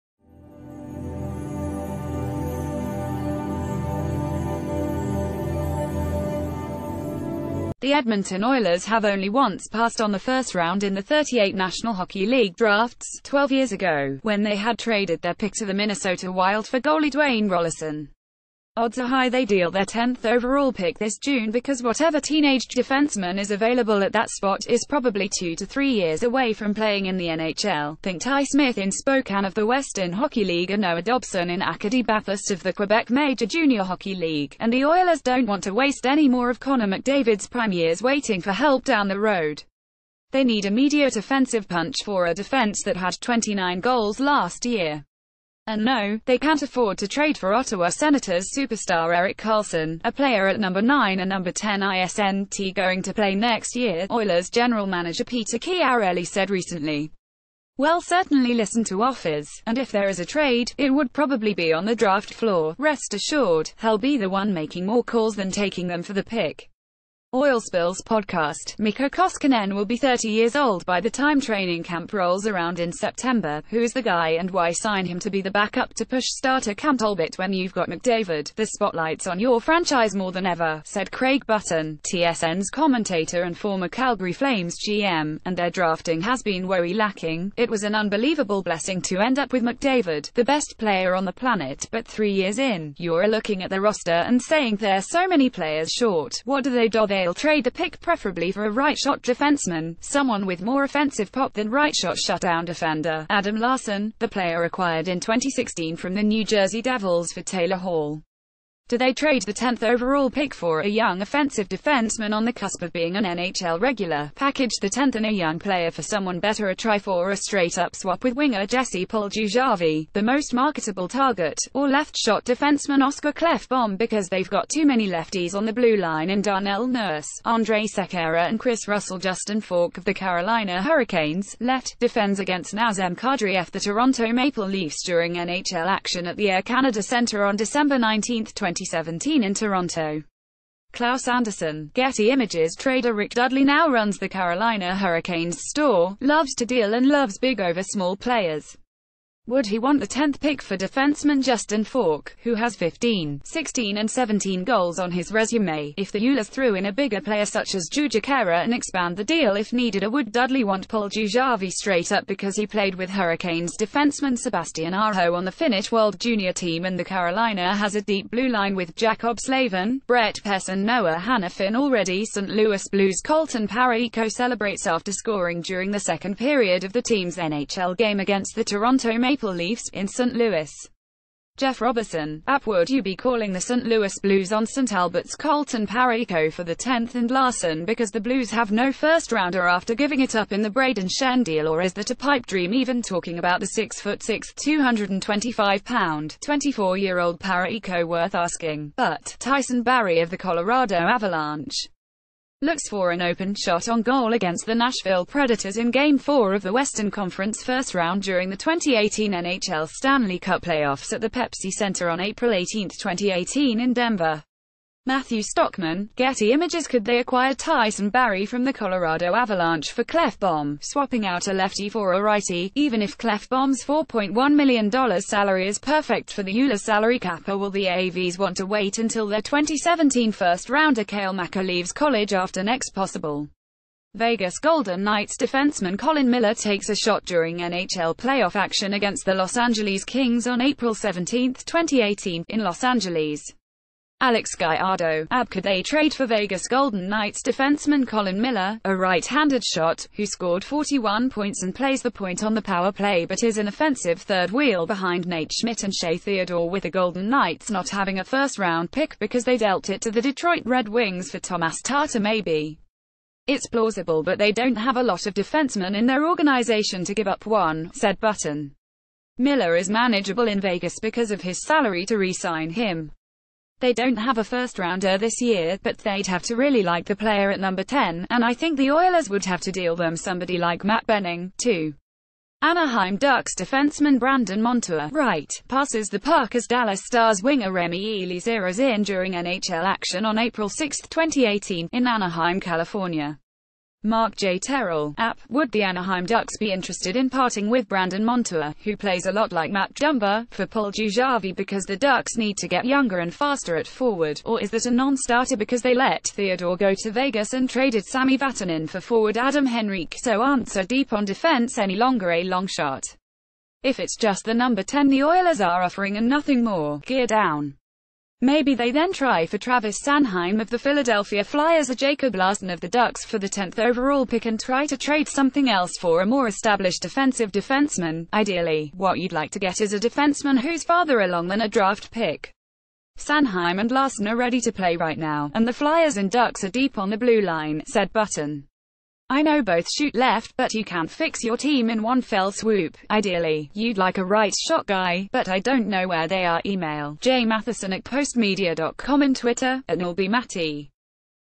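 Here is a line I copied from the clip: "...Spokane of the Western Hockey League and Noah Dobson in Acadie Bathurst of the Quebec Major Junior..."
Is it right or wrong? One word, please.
right.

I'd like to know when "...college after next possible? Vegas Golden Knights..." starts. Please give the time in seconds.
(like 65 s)
231 s.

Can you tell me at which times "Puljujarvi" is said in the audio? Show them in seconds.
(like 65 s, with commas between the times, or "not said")
119 s, 160 s, 300 s.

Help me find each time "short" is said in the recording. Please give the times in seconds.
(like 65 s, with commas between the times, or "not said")
95 s.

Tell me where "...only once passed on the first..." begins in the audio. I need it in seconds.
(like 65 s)
9 s.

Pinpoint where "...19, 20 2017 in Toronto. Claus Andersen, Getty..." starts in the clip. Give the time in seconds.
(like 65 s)
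137 s.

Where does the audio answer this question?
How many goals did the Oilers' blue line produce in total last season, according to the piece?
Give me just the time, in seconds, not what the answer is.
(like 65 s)
43 s.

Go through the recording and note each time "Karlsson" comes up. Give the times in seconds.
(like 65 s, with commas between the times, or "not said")
49 s.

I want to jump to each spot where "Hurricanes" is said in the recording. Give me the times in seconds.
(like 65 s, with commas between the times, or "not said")
130 s, 144 s, 163 s.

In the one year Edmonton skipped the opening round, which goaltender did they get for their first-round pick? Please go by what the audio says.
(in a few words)
Dwayne Roloson.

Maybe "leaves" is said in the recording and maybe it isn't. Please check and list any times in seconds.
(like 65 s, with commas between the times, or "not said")
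231 s.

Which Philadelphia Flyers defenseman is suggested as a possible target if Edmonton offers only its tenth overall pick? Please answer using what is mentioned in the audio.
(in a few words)
Travis Sanheim.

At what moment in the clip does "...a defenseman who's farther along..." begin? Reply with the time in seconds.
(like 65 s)
329 s.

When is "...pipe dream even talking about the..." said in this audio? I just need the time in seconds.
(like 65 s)
192 s.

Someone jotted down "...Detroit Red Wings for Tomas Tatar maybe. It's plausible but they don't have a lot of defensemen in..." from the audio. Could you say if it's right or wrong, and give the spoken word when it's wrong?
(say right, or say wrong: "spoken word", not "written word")
right.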